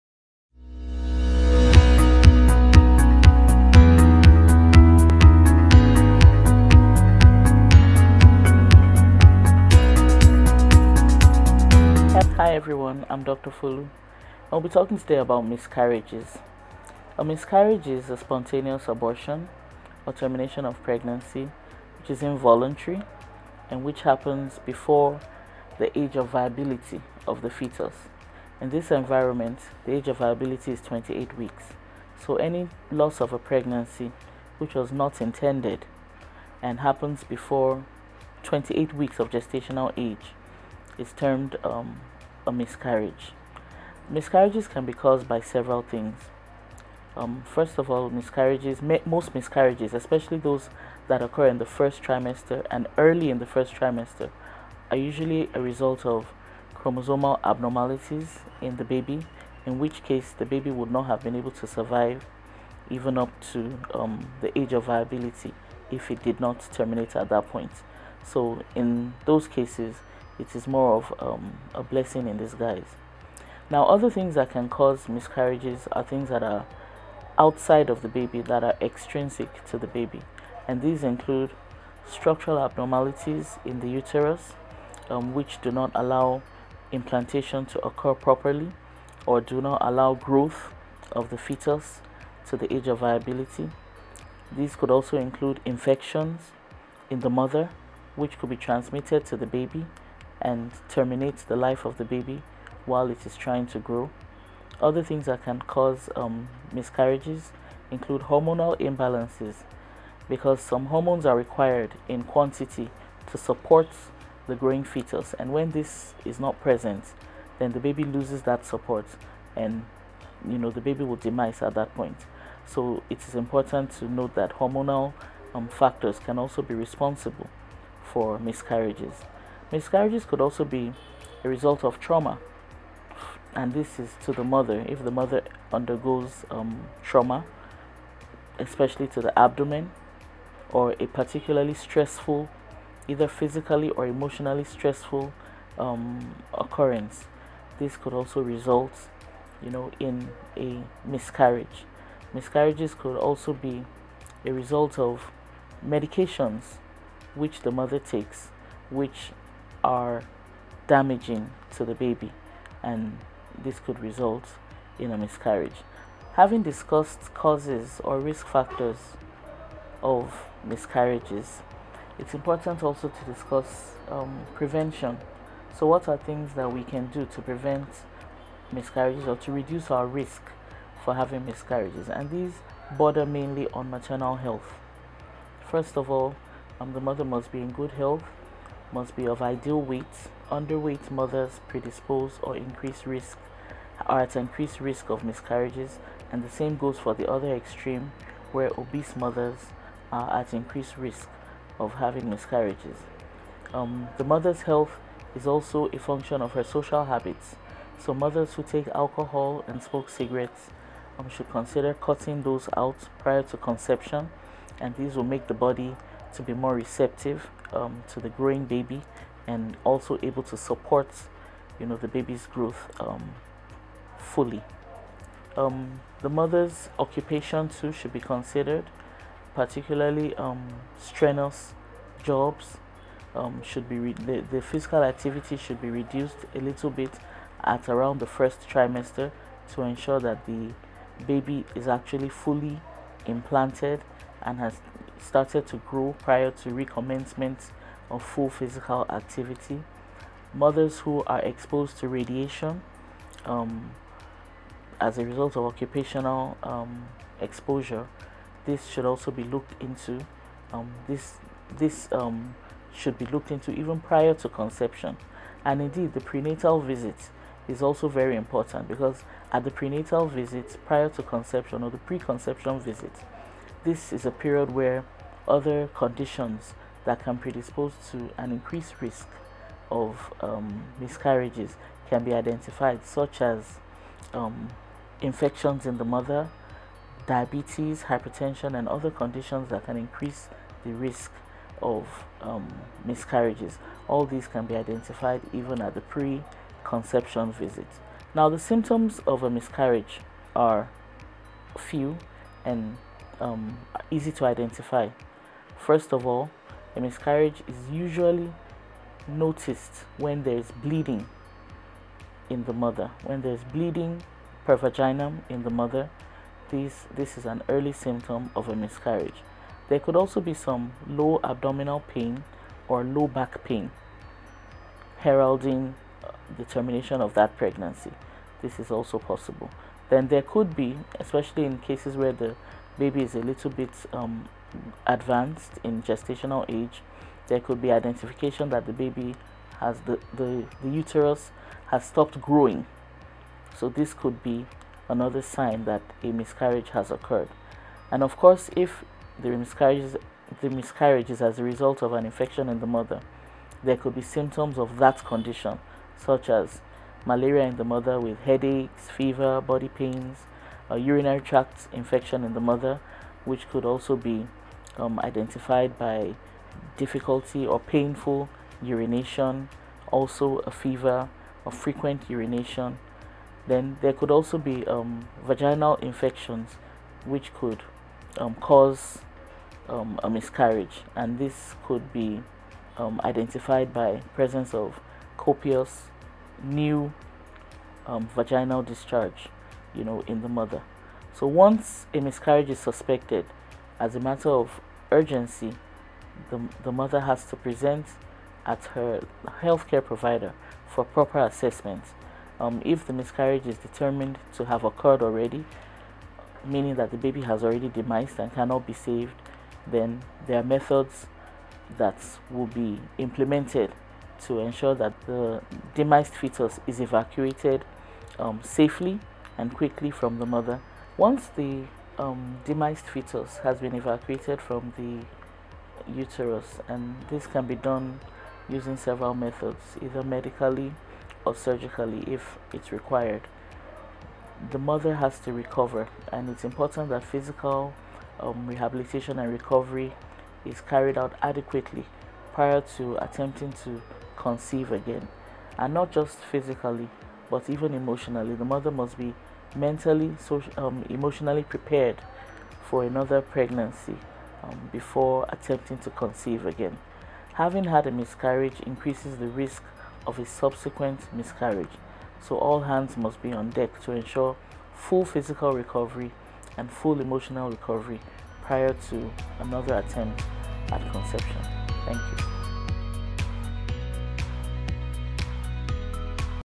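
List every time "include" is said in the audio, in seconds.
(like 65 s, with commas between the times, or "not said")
81 s, 95 s, 107 s.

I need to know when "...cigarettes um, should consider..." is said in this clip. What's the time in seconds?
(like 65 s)
210 s.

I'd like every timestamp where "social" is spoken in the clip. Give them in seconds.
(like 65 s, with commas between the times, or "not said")
206 s, 450 s.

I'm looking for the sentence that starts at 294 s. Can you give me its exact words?
All these can be identified even at the pre-conception visit.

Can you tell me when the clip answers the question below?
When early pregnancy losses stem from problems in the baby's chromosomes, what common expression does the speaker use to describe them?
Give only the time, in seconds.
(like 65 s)
71 s.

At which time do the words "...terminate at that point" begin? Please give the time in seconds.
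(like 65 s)
66 s.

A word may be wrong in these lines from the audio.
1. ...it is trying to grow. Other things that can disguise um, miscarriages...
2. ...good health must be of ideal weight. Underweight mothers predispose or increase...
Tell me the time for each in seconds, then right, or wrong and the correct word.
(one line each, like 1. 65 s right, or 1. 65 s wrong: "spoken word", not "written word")
1. 103 s wrong: "cause", not "disguise"
2. 187 s right.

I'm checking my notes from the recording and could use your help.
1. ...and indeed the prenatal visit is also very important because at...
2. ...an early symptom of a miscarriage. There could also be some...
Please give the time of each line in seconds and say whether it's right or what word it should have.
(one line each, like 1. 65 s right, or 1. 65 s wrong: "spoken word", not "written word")
1. 265 s right
2. 317 s right.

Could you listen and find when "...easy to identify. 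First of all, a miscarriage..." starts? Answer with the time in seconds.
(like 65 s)
304 s.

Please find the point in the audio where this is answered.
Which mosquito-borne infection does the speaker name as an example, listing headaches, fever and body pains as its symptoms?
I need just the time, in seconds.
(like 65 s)
357 s.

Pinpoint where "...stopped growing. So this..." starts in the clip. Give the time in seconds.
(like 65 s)
342 s.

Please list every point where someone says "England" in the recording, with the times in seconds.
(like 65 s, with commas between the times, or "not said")
not said.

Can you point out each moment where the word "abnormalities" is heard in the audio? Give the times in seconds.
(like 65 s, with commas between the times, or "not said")
57 s, 82 s.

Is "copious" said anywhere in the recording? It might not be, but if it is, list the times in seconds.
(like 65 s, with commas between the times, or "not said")
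385 s.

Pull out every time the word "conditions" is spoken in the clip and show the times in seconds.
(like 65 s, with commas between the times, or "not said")
275 s, 289 s, 355 s.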